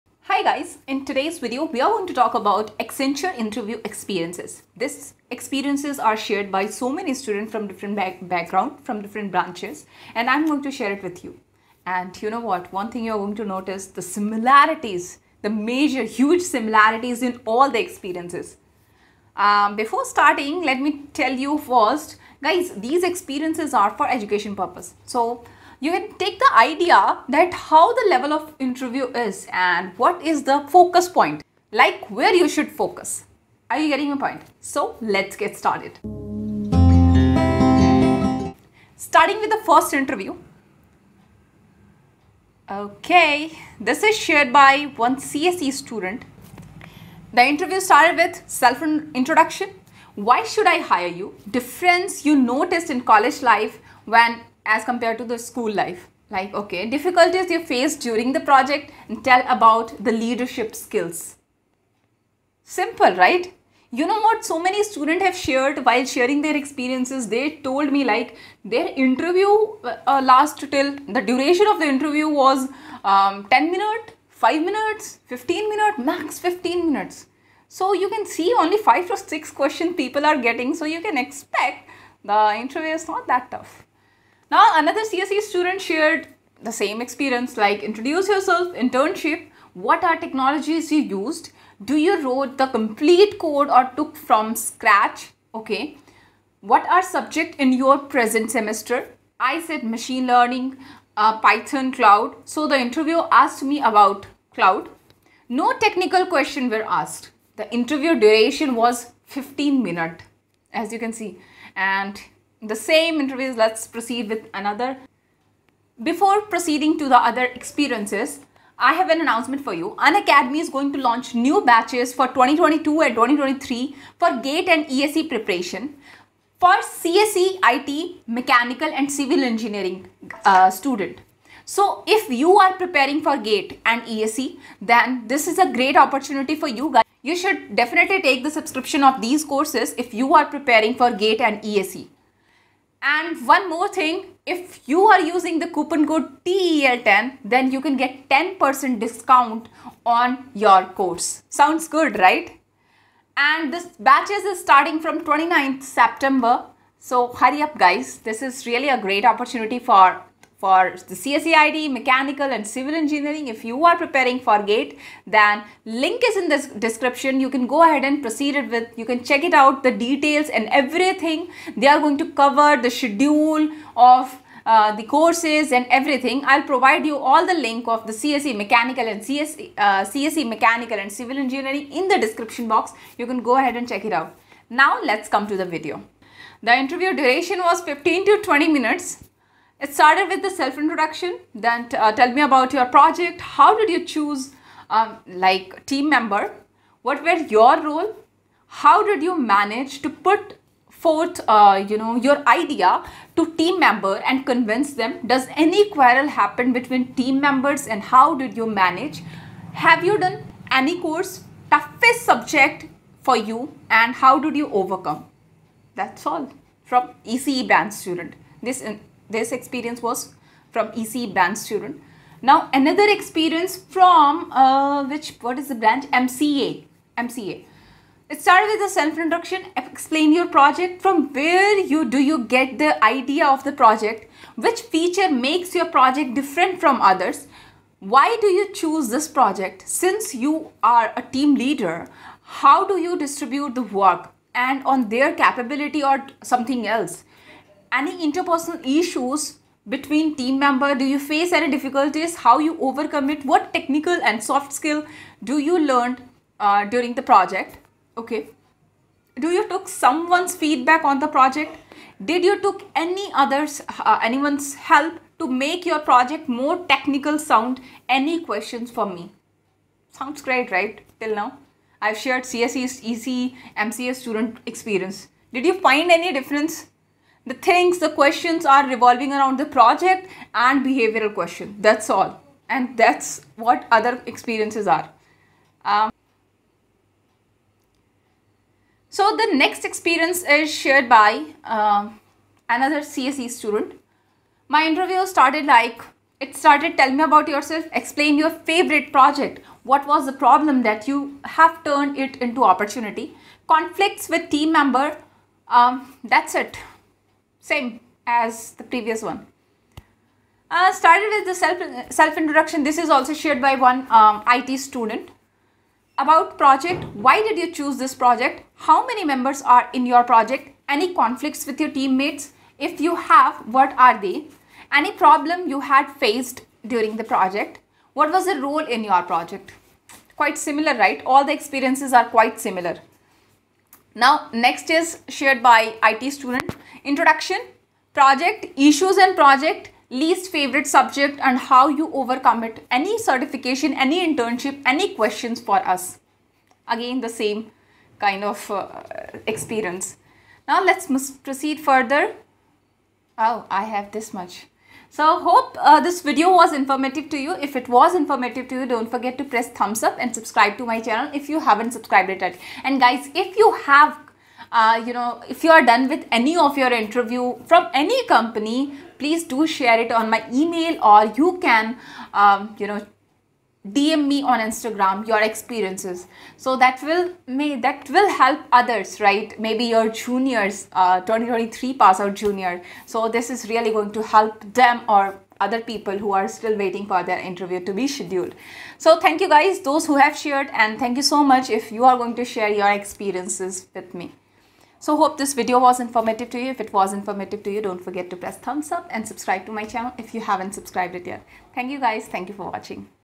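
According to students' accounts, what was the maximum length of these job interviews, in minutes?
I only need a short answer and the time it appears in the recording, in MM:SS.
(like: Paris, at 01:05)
15, at 01:15.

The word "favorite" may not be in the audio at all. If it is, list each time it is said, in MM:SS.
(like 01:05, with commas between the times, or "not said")
04:58, 05:40.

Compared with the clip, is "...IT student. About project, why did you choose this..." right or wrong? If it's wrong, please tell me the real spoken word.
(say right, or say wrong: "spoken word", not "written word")
right.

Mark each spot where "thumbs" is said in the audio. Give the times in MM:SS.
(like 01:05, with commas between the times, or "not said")
05:59, 06:38.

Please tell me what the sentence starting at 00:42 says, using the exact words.
Okay, this is shared by one CSE student.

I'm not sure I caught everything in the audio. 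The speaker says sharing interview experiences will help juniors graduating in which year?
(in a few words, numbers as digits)
2023.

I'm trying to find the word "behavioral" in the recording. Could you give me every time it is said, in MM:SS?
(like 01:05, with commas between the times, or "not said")
04:40.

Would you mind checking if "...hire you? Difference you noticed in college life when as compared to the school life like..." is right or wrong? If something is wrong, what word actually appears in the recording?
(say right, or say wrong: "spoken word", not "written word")
right.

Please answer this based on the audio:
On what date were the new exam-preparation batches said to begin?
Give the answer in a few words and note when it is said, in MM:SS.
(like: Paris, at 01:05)
29th September, at 02:35.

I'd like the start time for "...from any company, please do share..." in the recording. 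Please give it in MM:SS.
06:07.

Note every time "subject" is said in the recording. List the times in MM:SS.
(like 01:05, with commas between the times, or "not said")
01:37, 03:32, 05:40.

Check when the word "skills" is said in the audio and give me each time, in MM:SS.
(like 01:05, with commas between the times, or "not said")
01:00, 04:14.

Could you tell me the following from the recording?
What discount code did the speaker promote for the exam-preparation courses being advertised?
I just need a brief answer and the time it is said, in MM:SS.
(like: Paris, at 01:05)
TEL10, at 02:26.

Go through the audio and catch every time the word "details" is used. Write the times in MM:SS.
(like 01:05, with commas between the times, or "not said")
02:50.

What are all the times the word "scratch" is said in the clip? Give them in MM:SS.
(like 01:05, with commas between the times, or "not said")
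01:34.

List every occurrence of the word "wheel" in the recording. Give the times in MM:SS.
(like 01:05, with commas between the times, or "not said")
not said.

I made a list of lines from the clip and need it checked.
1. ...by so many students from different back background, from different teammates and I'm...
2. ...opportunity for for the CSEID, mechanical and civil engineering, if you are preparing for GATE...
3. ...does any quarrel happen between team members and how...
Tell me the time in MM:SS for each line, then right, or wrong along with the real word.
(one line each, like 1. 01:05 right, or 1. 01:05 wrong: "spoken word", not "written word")
1. 00:06 wrong: "branches", not "teammates"
2. 02:39 right
3. 03:25 right.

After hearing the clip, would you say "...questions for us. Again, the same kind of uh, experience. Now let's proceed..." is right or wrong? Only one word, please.
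right.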